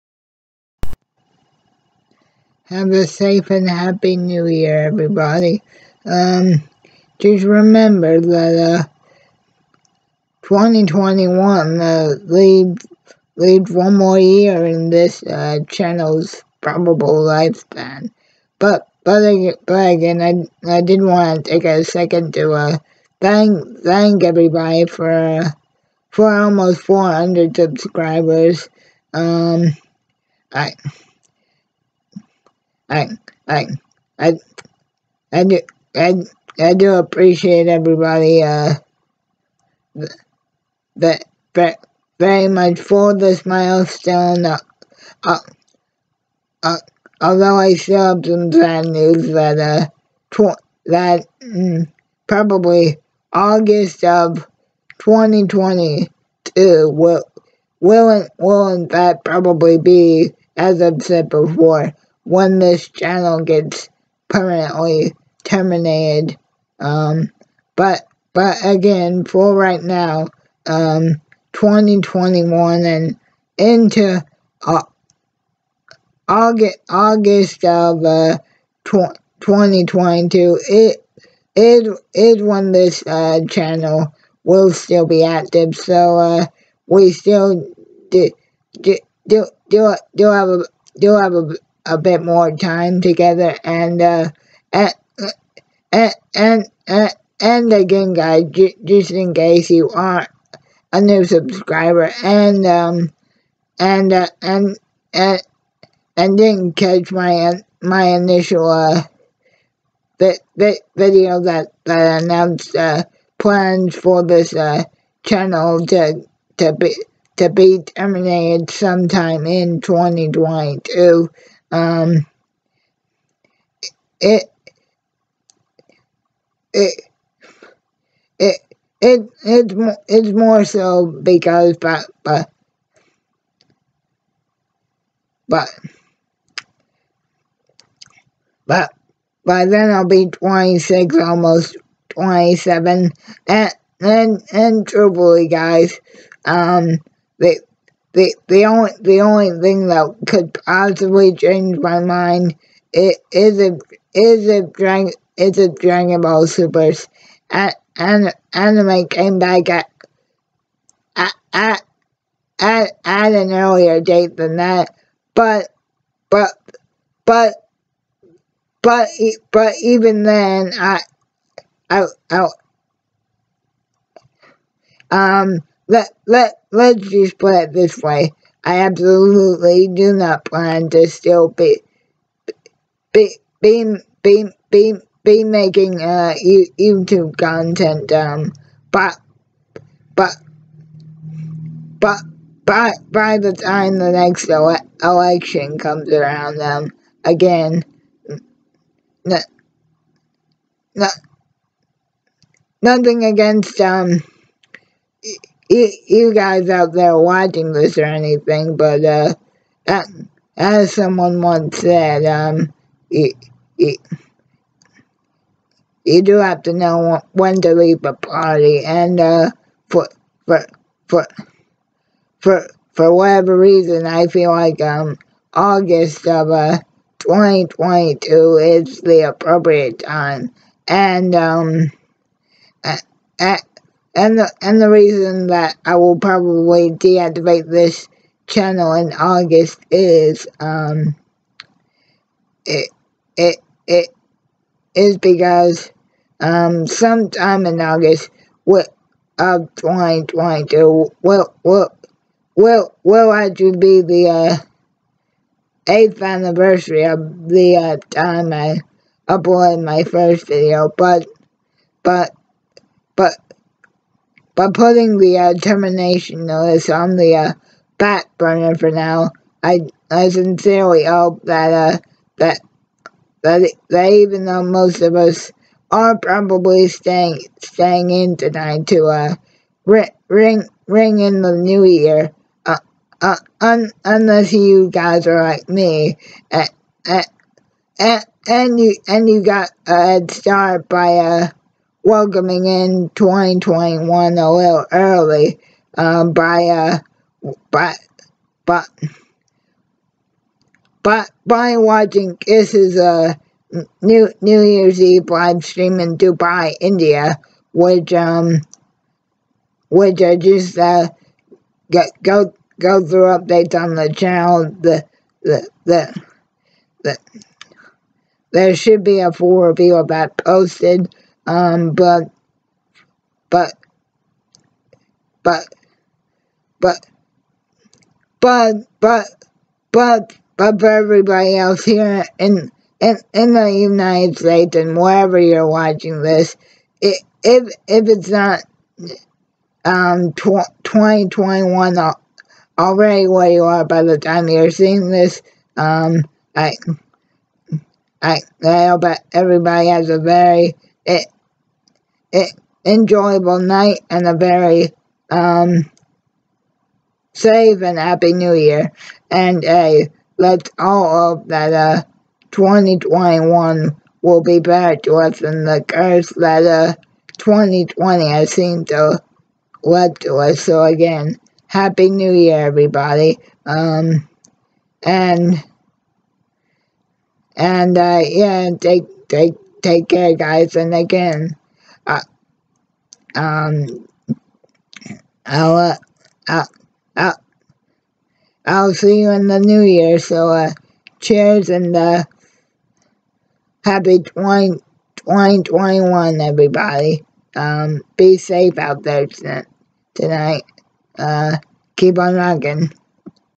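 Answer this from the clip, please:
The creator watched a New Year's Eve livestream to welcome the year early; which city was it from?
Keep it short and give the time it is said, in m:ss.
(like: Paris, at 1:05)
Dubai, at 5:06.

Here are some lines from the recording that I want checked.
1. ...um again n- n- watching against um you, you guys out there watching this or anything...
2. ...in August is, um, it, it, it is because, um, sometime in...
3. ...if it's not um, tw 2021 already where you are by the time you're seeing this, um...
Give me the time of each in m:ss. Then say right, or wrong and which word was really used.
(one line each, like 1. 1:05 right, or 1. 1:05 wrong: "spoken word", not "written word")
1. 3:16 wrong: "nothing", not "watching"
2. 3:58 right
3. 5:37 right.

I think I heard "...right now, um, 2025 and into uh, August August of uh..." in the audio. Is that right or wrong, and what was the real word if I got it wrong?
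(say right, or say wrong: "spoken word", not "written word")
wrong: "2021", not "2025".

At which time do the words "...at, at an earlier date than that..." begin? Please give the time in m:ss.
2:42.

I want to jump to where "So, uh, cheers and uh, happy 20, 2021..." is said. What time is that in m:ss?
6:30.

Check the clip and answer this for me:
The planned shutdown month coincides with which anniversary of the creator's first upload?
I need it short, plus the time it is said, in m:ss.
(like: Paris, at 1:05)
Eighth, at 4:15.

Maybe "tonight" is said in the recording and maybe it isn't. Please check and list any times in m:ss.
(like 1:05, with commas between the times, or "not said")
4:38, 6:40.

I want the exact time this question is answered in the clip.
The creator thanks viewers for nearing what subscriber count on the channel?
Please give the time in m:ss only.
0:26.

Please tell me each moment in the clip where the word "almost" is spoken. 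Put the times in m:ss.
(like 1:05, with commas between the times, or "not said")
0:26, 2:21.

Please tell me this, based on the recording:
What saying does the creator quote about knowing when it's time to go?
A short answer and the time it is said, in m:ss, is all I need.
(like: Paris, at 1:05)
Know when to leave a party, at 3:36.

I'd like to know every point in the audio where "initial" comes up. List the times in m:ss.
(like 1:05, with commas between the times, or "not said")
1:48.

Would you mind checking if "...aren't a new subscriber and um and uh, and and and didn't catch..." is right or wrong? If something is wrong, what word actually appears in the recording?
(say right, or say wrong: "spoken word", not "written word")
right.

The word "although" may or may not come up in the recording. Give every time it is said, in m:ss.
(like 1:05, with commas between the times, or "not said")
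0:47.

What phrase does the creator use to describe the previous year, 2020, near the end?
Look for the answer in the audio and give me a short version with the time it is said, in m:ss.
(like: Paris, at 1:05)
The curse, at 6:05.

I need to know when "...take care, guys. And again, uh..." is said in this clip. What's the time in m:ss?
6:19.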